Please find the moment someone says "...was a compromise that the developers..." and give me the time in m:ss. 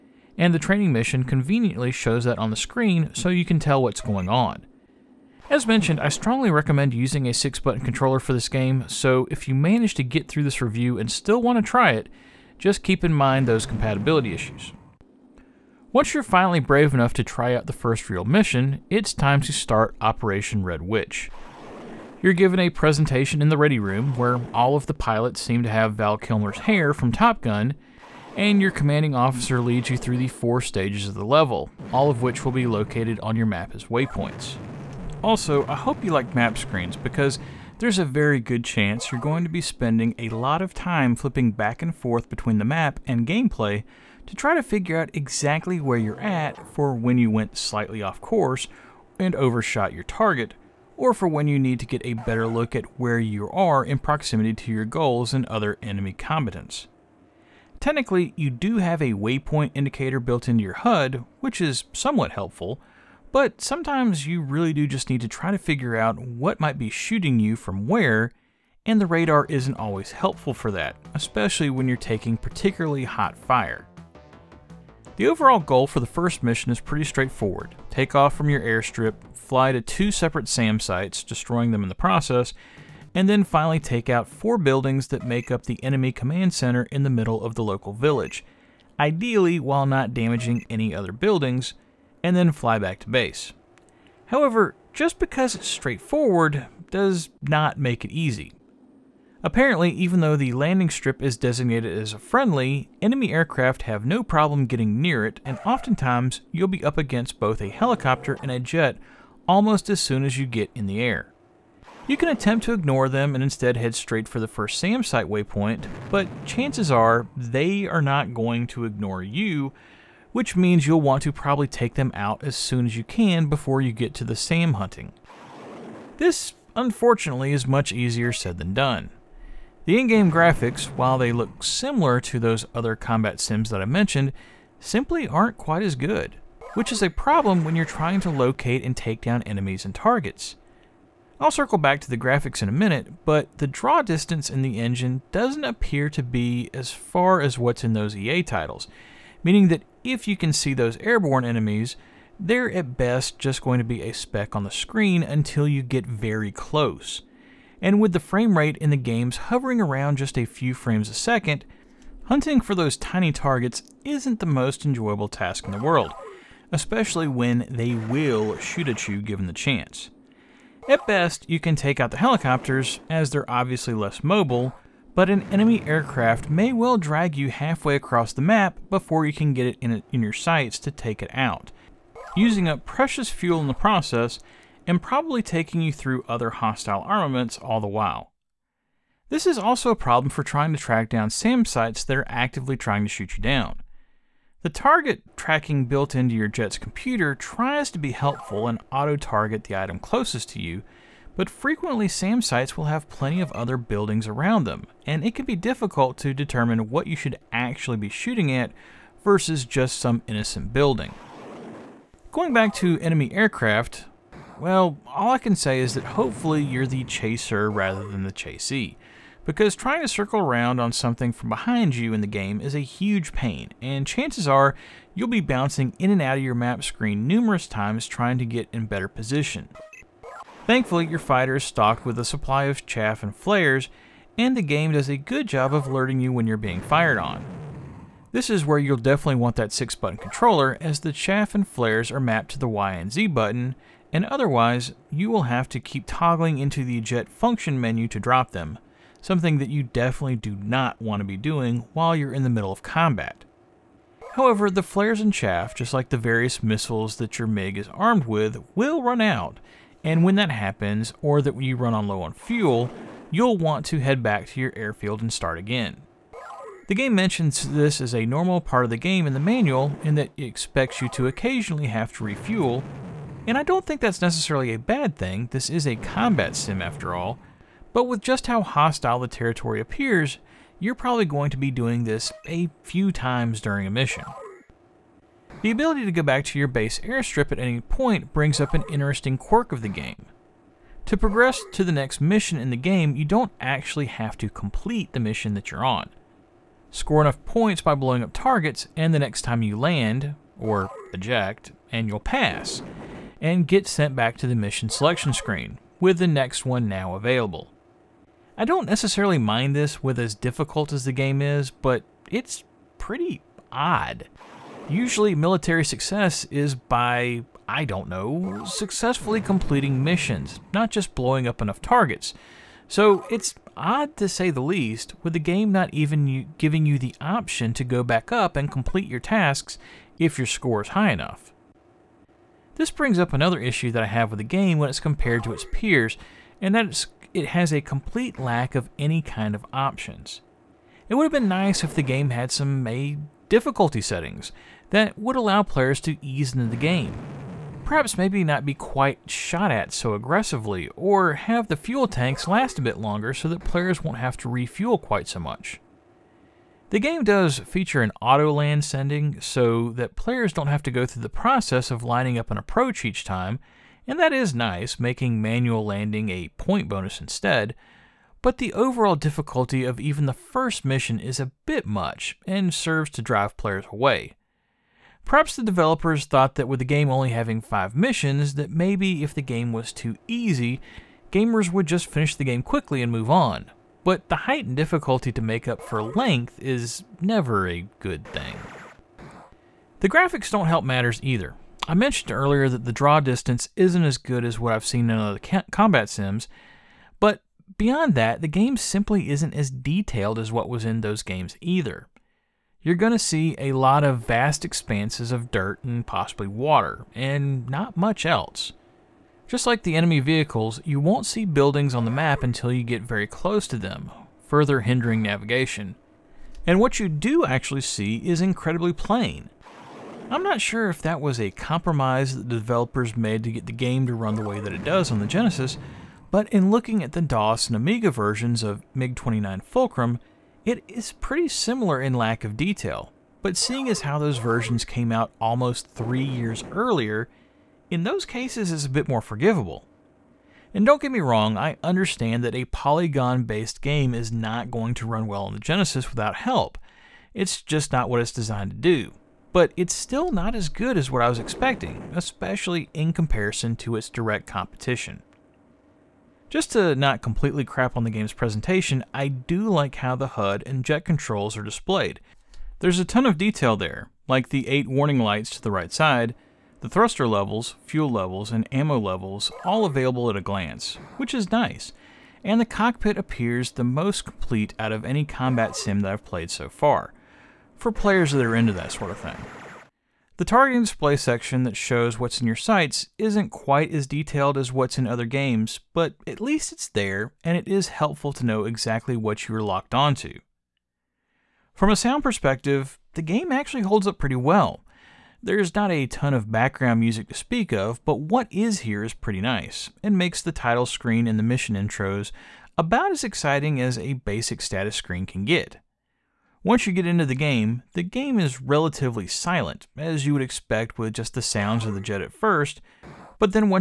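7:01.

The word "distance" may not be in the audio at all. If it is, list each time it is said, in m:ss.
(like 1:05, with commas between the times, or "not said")
2:24, 6:33.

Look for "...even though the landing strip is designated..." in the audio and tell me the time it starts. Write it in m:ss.
1:39.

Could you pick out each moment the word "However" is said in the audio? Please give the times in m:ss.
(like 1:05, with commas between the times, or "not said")
1:34, 4:14.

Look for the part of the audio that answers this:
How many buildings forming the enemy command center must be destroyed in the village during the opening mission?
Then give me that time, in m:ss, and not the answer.
1:24.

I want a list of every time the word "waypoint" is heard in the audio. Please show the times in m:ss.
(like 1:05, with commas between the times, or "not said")
0:33, 0:59, 1:55.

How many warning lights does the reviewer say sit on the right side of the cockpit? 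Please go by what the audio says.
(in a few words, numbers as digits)
8.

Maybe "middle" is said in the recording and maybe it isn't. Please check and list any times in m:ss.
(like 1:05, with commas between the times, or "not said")
1:27, 4:12.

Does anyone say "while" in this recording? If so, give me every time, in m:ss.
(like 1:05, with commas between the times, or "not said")
1:29, 2:10, 3:07, 4:11.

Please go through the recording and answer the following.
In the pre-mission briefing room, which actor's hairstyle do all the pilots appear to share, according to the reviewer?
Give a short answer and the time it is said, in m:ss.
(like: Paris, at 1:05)
Val Kilmer, at 0:25.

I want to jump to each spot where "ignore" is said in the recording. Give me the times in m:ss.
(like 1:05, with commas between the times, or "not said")
1:52, 1:58.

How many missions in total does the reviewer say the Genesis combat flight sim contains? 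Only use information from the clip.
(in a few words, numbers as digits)
5.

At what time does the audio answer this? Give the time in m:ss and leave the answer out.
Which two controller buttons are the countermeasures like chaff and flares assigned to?
4:02.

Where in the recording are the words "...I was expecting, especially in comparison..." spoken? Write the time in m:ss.
7:31.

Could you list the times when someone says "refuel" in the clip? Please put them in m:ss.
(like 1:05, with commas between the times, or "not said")
4:32, 5:54.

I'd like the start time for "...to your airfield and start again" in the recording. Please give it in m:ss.
4:24.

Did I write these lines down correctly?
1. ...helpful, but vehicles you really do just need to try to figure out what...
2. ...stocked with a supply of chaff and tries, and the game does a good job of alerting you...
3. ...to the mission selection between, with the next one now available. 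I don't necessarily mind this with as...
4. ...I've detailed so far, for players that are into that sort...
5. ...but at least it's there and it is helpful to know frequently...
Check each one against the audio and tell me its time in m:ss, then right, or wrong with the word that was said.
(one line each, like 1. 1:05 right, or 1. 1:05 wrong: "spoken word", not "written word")
1. 1:02 wrong: "sometimes", not "vehicles"
2. 3:51 wrong: "flares", not "tries"
3. 5:04 wrong: "screen", not "between"
4. 7:56 wrong: "played", not "detailed"
5. 8:05 wrong: "exactly", not "frequently".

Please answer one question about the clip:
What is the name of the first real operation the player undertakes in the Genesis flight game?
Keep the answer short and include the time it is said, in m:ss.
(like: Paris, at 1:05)
Operation Red Witch, at 0:20.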